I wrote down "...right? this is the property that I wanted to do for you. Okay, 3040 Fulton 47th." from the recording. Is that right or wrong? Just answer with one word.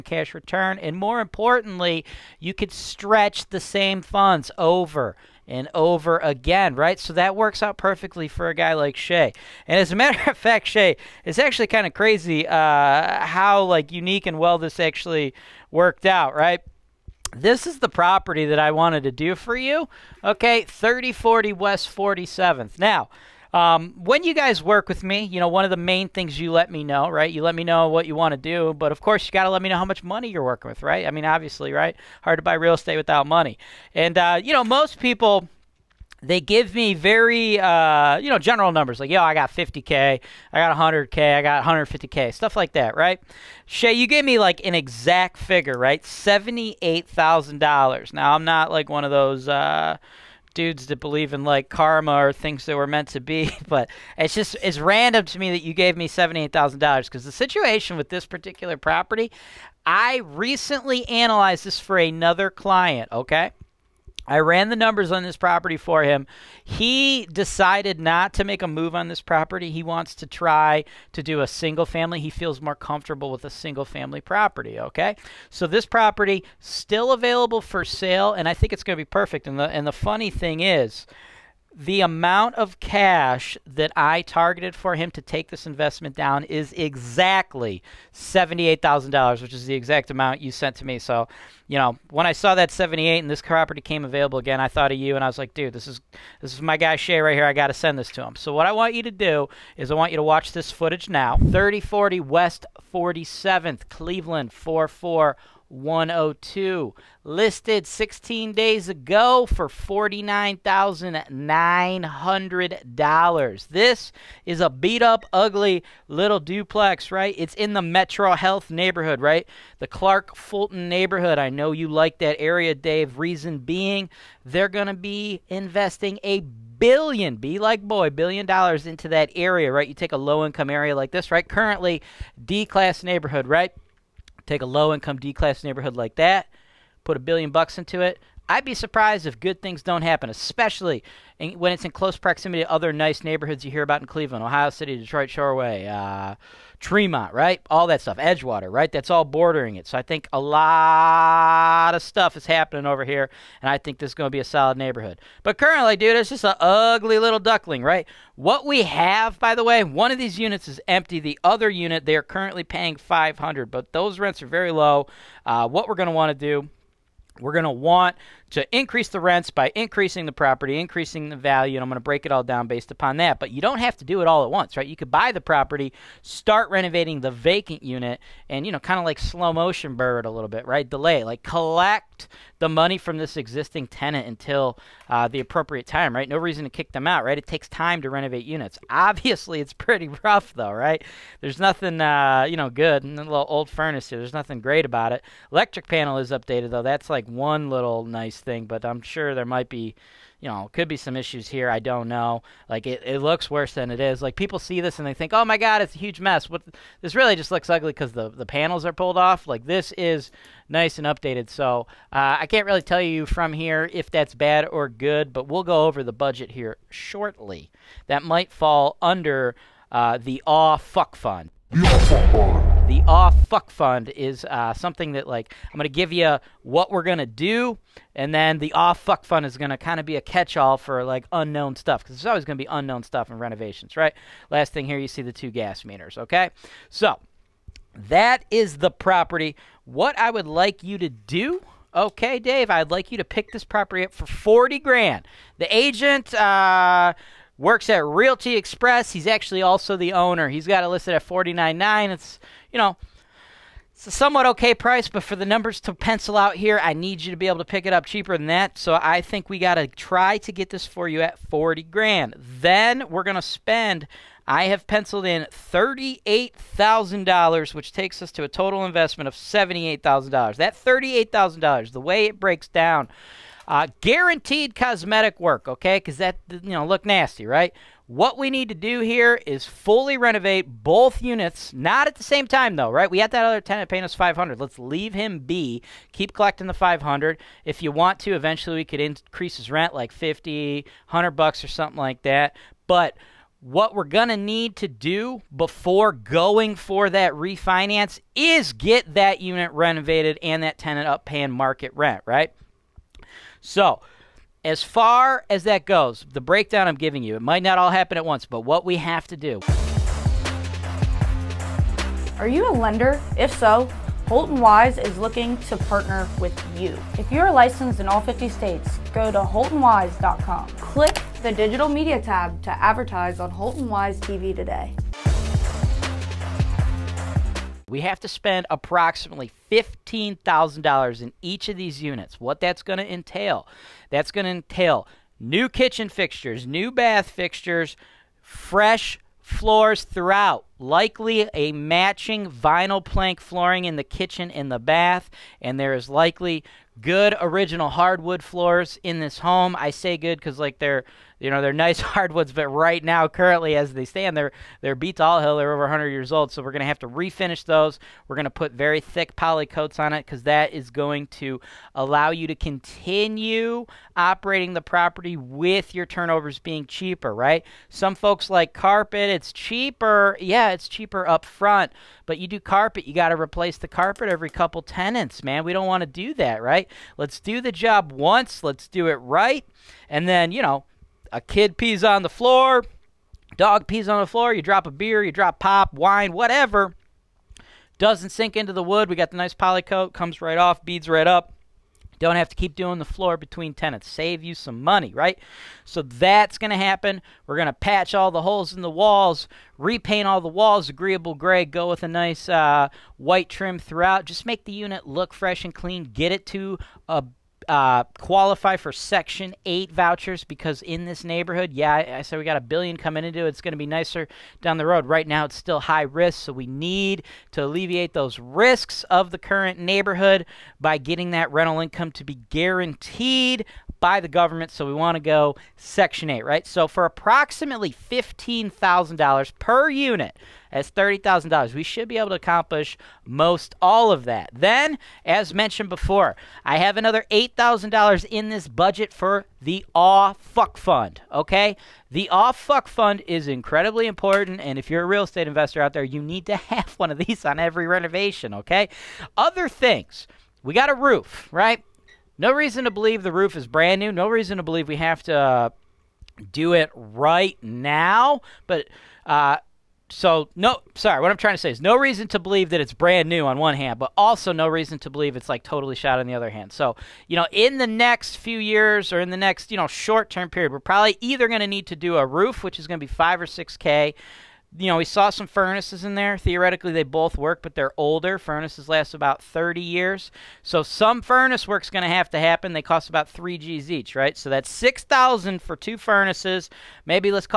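wrong.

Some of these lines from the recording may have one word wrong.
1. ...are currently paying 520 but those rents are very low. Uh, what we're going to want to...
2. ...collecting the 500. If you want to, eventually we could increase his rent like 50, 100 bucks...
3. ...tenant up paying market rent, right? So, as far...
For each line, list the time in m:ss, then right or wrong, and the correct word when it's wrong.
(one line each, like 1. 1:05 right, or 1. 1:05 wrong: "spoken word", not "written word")
1. 2:42 wrong: "500", not "520"
2. 4:46 right
3. 5:00 right.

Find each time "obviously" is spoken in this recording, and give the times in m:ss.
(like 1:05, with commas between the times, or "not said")
0:31, 3:08.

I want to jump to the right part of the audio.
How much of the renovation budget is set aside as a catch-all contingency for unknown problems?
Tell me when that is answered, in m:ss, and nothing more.
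7:17.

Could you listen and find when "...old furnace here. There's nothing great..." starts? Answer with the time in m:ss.
3:13.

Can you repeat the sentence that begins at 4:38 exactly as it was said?
What we need to do here is fully renovate both units, not at the same time though, right?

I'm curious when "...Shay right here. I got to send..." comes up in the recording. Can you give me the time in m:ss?
1:36.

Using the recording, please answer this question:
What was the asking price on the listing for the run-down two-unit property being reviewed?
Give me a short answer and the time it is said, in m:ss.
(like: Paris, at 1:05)
$49,900, at 1:49.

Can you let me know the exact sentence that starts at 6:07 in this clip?
Some folks like carpet; it's cheaper.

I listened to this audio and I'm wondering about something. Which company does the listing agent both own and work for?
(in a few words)
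Realty Express.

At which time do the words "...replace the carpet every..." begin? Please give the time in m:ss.
6:13.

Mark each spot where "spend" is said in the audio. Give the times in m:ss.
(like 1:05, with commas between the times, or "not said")
4:23, 5:28.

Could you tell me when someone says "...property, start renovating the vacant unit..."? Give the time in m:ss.
2:55.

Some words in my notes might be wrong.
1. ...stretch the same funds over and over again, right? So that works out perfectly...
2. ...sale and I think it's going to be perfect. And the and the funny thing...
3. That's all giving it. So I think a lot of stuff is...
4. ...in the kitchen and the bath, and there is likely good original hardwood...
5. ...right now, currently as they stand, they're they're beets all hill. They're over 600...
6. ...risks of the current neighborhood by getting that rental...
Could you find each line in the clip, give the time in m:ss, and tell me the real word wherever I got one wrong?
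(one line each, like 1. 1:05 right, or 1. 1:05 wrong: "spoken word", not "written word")
1. 0:02 right
2. 1:17 right
3. 2:28 wrong: "bordering", not "giving"
4. 5:43 right
5. 5:52 wrong: "100", not "600"
6. 6:58 right.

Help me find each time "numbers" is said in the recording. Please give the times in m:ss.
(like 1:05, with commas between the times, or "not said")
0:38, 1:04, 4:15.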